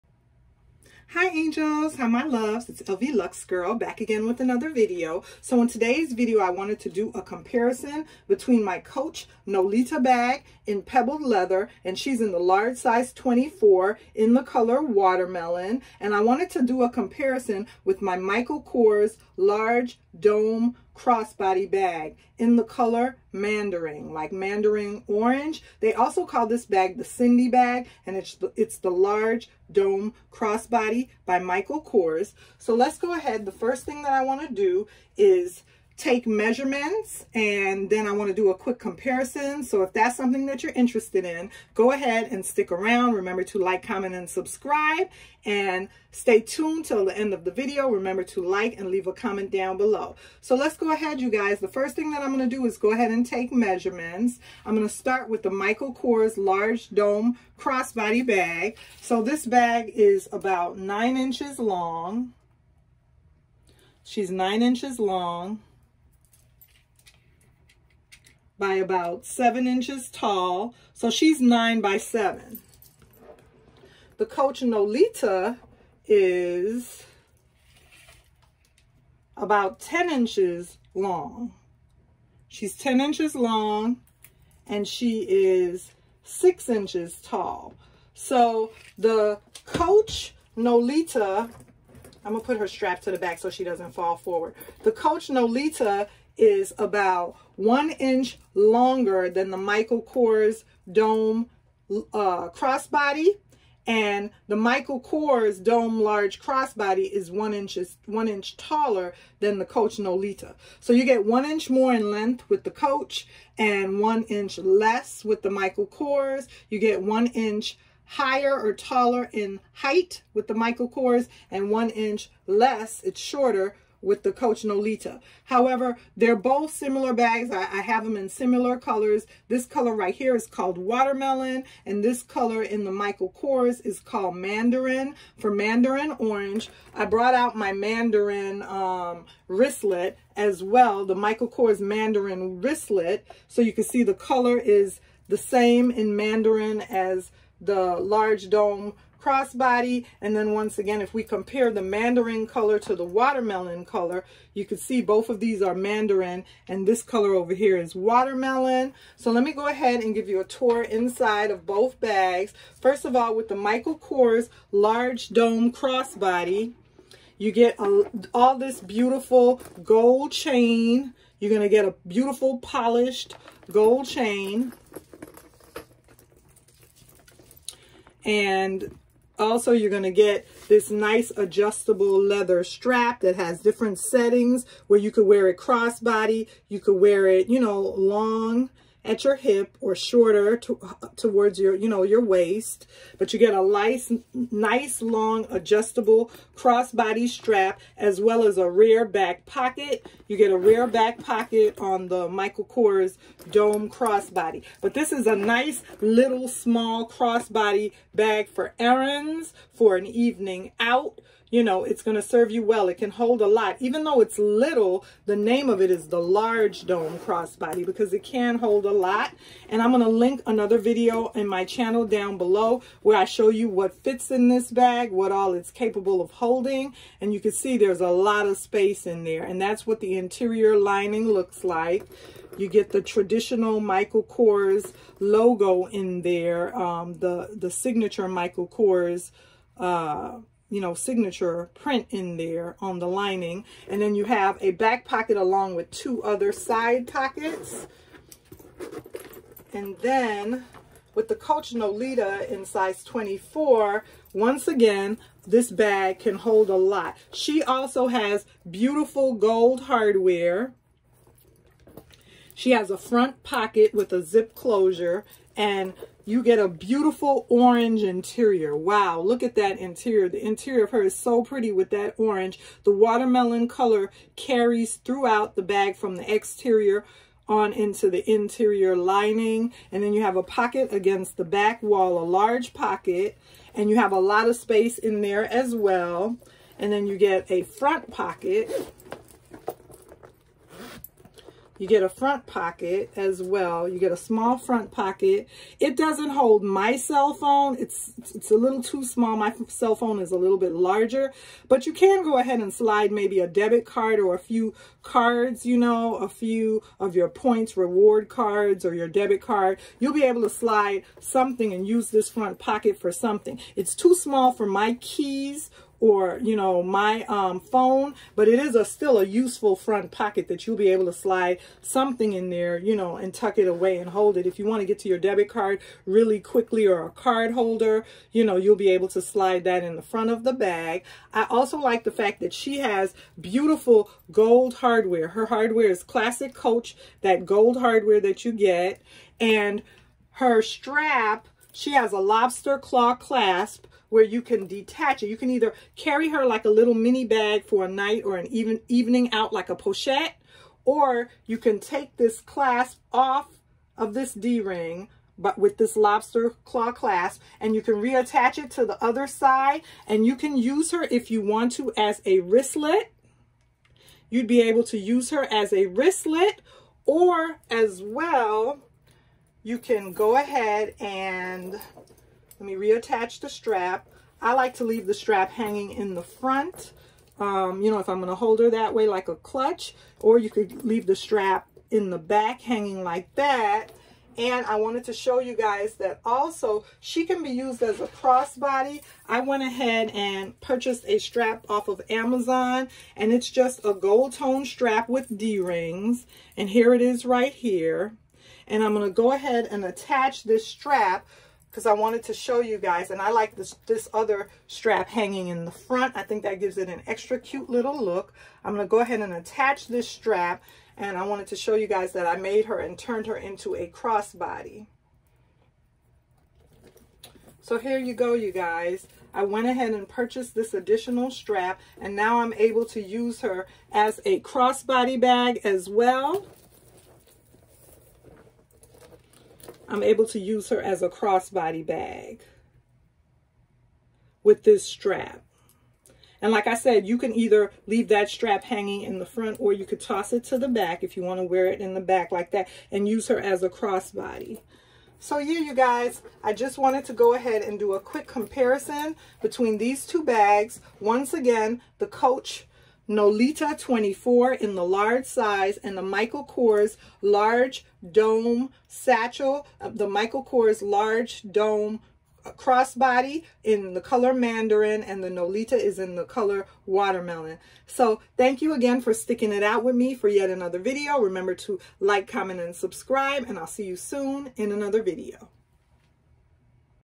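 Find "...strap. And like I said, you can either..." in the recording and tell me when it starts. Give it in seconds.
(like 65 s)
434 s.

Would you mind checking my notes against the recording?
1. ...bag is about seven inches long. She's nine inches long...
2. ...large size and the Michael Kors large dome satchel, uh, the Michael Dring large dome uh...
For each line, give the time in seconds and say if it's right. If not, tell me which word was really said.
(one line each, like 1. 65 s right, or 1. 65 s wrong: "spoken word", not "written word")
1. 59 s wrong: "nine", not "seven"
2. 454 s wrong: "Kors", not "Dring".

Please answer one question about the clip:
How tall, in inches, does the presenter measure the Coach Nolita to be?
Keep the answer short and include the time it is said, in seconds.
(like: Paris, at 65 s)
6 inches, at 86 s.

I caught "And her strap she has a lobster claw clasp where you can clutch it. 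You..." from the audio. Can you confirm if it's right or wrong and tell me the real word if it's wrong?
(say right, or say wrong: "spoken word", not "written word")
wrong: "detach", not "clutch".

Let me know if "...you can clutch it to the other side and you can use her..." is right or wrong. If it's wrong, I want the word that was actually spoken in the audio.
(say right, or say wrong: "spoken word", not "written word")
wrong: "reattach", not "clutch".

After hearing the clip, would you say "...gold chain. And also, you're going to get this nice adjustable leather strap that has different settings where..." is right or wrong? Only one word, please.
right.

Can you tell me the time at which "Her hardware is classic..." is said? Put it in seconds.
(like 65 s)
335 s.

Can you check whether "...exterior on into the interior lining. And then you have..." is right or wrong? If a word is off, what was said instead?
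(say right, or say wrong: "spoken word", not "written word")
right.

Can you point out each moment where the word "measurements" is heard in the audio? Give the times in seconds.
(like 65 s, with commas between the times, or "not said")
36 s, 53 s.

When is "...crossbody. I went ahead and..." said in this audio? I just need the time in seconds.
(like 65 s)
388 s.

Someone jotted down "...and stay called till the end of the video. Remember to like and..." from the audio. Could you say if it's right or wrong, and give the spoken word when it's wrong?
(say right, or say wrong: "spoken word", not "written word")
wrong: "tuned", not "called".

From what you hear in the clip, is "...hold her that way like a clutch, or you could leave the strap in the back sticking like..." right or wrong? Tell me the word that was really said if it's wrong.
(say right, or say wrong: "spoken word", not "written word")
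wrong: "hanging", not "sticking".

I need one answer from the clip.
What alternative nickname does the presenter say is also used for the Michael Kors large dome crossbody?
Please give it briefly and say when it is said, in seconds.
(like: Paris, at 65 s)
Cindy bag, at 27 s.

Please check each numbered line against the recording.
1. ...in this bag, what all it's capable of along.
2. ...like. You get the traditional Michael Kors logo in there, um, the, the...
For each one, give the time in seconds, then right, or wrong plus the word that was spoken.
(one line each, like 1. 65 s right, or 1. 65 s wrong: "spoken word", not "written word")
1. 224 s wrong: "holding", not "along"
2. 231 s right.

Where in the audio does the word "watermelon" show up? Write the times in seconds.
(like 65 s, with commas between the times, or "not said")
14 s, 130 s, 153 s, 157 s, 272 s, 466 s.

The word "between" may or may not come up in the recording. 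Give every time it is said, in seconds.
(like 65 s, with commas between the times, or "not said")
8 s, 449 s.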